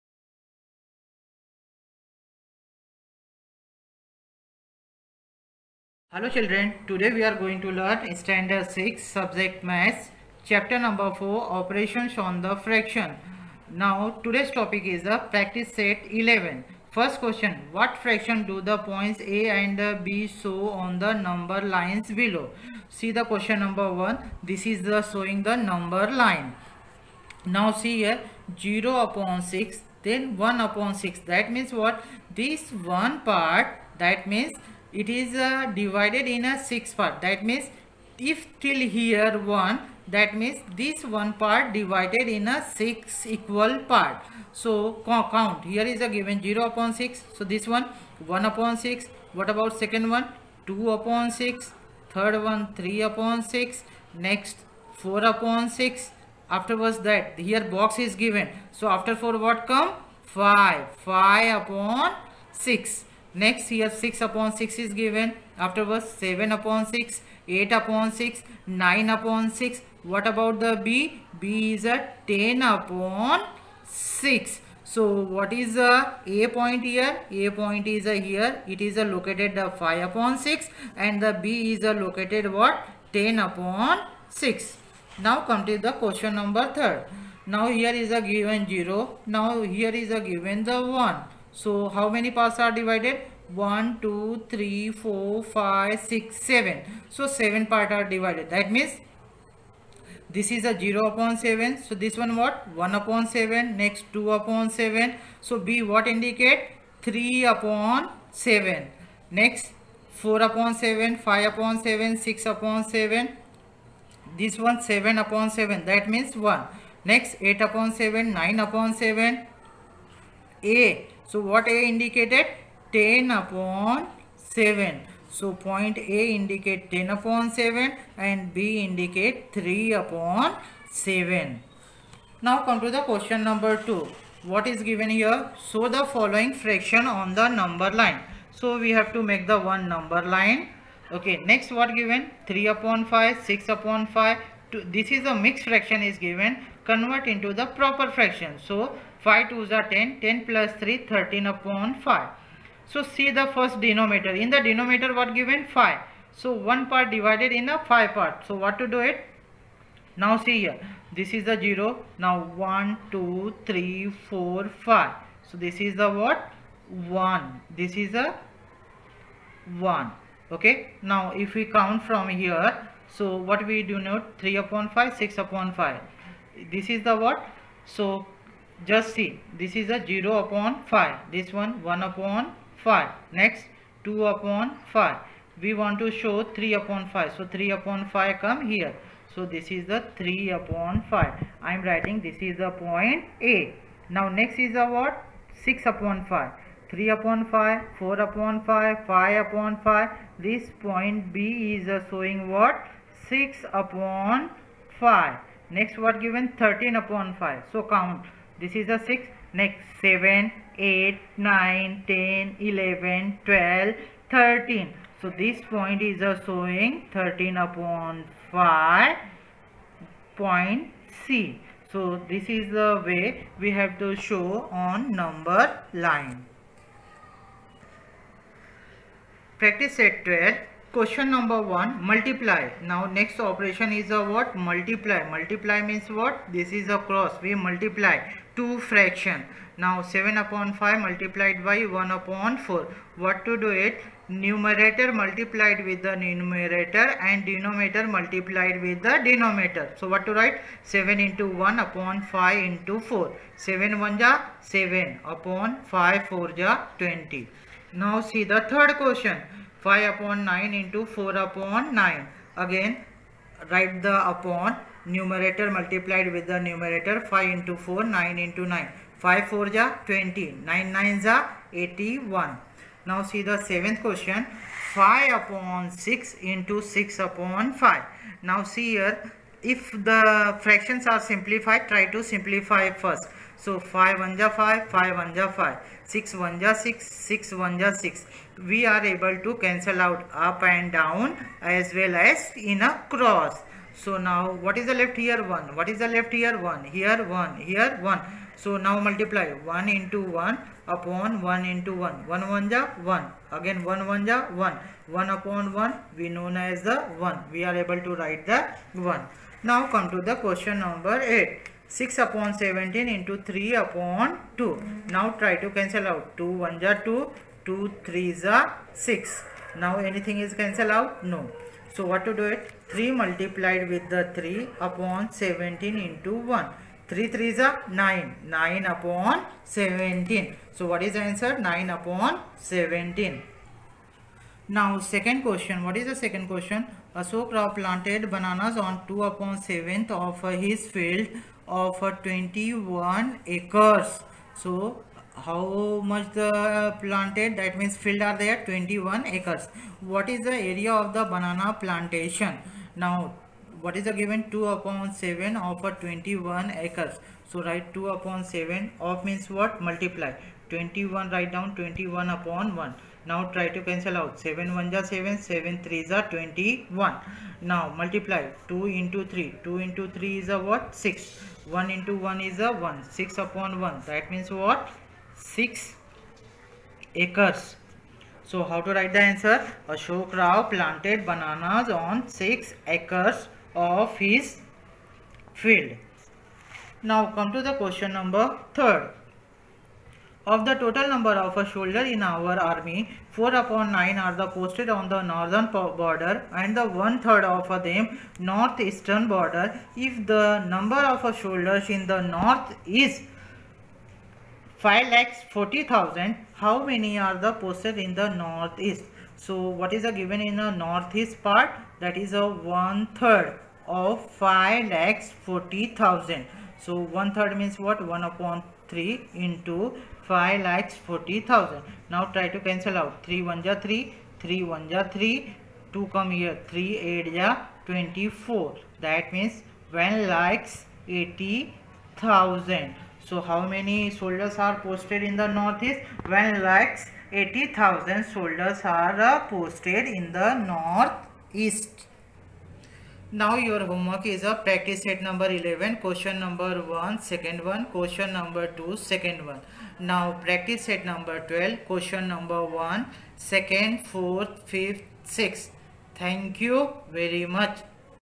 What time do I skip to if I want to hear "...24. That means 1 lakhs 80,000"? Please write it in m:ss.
7:07.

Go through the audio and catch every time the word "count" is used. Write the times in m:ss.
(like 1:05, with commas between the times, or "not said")
0:45, 2:51, 3:27.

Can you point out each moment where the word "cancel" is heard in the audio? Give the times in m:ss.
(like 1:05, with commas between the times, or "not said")
4:49, 5:15, 5:20, 6:03, 7:02.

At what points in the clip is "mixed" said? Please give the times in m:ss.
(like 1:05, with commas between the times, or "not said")
2:25.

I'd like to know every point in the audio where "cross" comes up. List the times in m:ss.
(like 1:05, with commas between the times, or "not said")
3:57, 4:53.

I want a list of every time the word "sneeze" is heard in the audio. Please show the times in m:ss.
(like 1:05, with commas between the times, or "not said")
not said.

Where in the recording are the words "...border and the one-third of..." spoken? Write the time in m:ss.
6:35.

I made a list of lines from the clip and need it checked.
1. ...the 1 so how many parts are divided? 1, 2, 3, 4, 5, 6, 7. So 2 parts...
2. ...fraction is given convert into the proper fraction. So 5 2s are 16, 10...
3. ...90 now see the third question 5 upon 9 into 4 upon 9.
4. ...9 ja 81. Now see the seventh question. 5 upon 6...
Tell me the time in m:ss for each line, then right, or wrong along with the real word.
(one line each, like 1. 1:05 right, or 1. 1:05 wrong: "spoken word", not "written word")
1. 1:30 wrong: "7", not "2"
2. 2:25 wrong: "10", not "16"
3. 4:17 wrong: "20", not "90"
4. 4:30 right.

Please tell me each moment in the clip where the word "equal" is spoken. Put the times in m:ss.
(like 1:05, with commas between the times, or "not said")
0:43.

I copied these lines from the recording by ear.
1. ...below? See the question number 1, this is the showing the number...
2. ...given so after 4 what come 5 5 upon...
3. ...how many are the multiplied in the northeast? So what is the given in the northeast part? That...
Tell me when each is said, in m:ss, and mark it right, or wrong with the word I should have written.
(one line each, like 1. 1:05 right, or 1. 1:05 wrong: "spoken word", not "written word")
1. 0:22 right
2. 0:58 right
3. 6:46 wrong: "posted", not "multiplied".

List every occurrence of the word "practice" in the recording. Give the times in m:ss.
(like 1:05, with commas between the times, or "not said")
0:15, 3:49, 7:24, 7:30.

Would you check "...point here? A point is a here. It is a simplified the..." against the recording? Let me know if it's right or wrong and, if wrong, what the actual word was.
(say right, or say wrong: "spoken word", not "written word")
wrong: "located", not "simplified".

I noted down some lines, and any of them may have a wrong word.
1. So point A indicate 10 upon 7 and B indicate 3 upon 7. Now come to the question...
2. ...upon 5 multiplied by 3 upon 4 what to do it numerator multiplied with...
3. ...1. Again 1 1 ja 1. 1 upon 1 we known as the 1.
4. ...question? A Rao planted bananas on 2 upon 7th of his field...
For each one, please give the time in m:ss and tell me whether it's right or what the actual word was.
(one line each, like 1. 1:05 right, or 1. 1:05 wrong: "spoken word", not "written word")
1. 2:05 right
2. 4:00 wrong: "1", not "3"
3. 5:03 right
4. 5:36 right.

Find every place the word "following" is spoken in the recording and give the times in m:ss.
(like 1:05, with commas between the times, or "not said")
2:16.